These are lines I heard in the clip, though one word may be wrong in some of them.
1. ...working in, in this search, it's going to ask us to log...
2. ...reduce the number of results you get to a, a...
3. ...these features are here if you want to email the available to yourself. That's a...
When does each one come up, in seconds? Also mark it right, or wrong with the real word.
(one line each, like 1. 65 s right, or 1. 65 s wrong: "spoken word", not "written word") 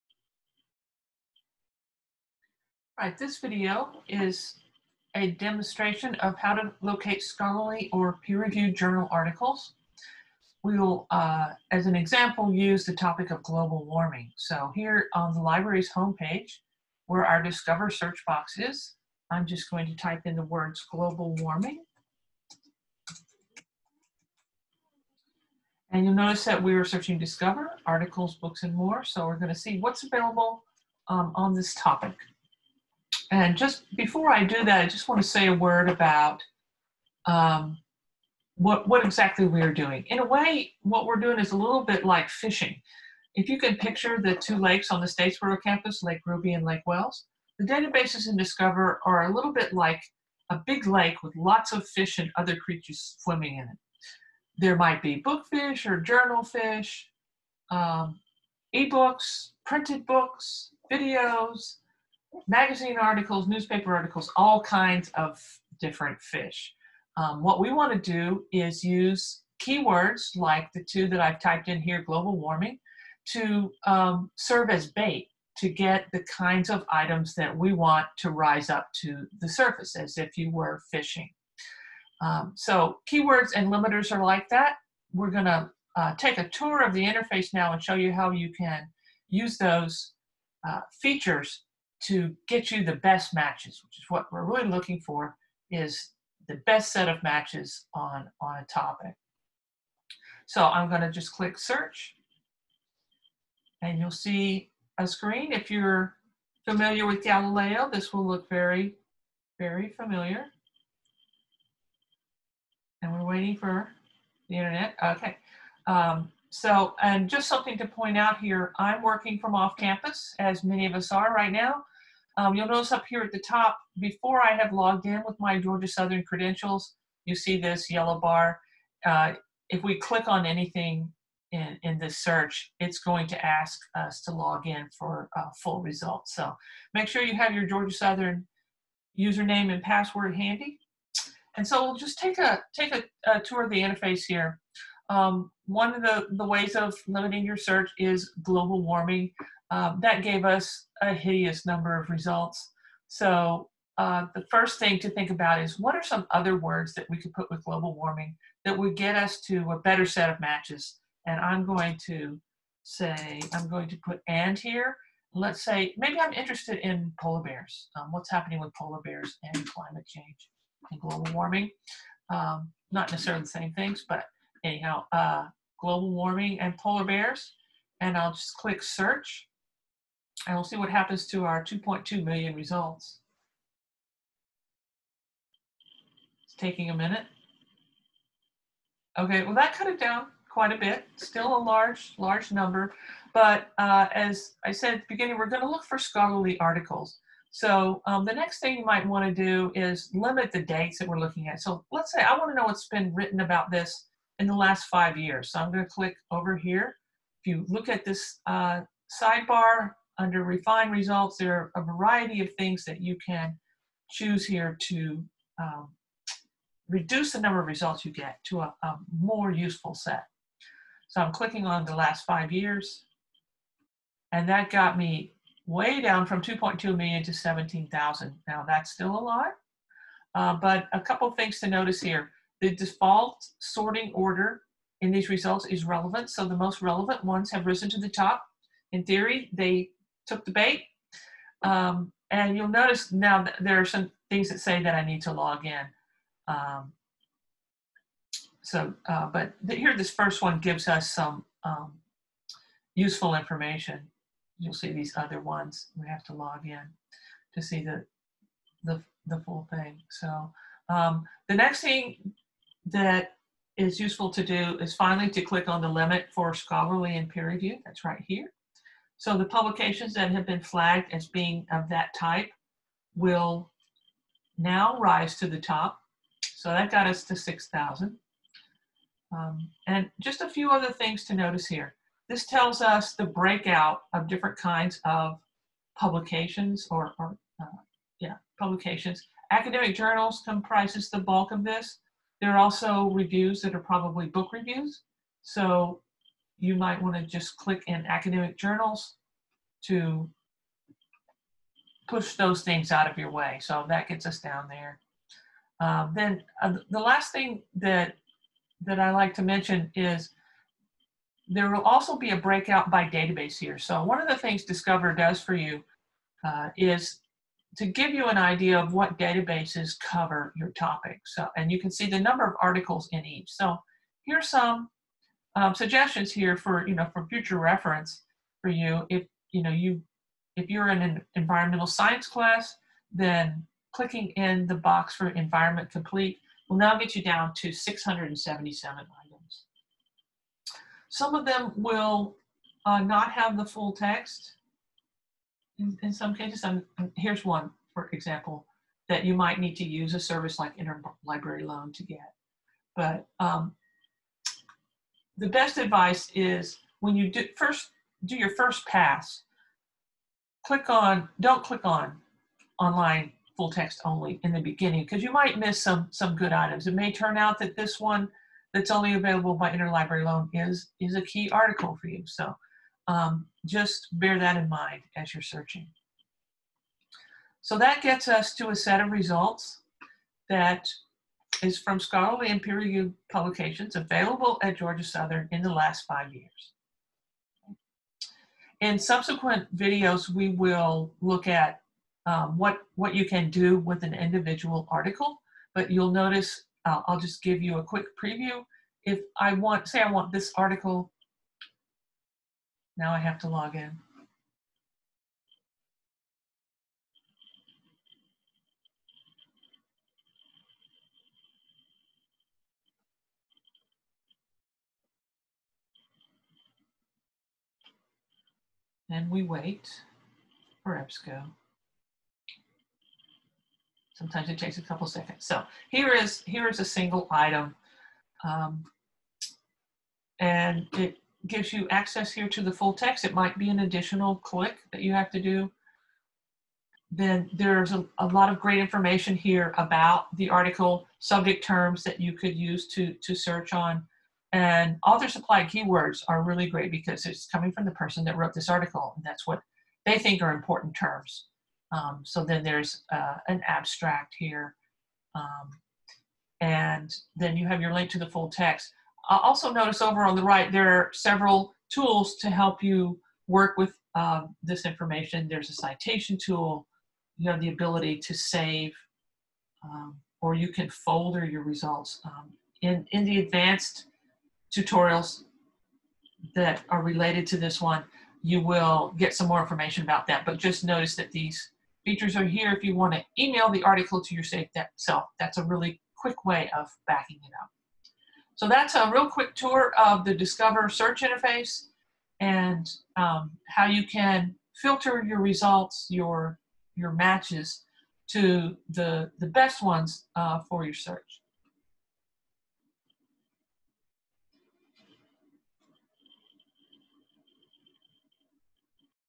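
1. 130 s wrong: "anything", not "working"
2. 216 s right
3. 481 s wrong: "article", not "available".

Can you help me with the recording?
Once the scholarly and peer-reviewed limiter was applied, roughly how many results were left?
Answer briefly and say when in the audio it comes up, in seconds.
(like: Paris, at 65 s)
6,000, at 277 s.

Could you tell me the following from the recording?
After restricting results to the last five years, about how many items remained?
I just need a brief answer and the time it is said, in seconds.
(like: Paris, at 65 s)
17,000, at 227 s.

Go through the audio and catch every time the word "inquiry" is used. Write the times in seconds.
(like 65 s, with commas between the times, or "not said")
not said.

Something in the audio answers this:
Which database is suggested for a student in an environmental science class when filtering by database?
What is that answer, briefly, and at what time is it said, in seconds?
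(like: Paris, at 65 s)
Environment Complete, at 335 s.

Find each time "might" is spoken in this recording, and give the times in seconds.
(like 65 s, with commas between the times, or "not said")
54 s, 198 s, 296 s, 349 s, 365 s, 433 s.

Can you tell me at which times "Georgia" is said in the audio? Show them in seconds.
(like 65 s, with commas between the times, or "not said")
125 s, 137 s, 384 s.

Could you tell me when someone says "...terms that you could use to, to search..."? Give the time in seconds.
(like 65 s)
441 s.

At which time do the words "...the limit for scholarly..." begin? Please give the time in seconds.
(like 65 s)
265 s.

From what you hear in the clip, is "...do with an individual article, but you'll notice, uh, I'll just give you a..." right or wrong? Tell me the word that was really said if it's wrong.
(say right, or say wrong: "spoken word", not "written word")
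right.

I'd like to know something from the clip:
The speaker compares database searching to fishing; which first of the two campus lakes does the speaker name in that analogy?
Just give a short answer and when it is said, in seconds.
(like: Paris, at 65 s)
Lake Ruby, at 46 s.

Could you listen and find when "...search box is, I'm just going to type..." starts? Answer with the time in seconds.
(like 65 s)
17 s.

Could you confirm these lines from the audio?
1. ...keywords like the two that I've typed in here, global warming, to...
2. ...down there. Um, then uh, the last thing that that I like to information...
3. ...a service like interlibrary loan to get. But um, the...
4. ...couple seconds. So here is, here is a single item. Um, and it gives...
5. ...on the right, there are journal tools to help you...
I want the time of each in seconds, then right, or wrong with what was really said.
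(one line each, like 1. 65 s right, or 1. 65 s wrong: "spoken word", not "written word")
1. 69 s right
2. 304 s wrong: "mention", not "information"
3. 350 s right
4. 424 s right
5. 460 s wrong: "several", not "journal".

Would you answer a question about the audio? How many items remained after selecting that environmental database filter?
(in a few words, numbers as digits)
677.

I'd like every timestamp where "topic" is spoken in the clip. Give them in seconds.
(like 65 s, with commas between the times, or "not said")
12 s, 31 s, 98 s, 320 s.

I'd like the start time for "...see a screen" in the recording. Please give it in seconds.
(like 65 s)
104 s.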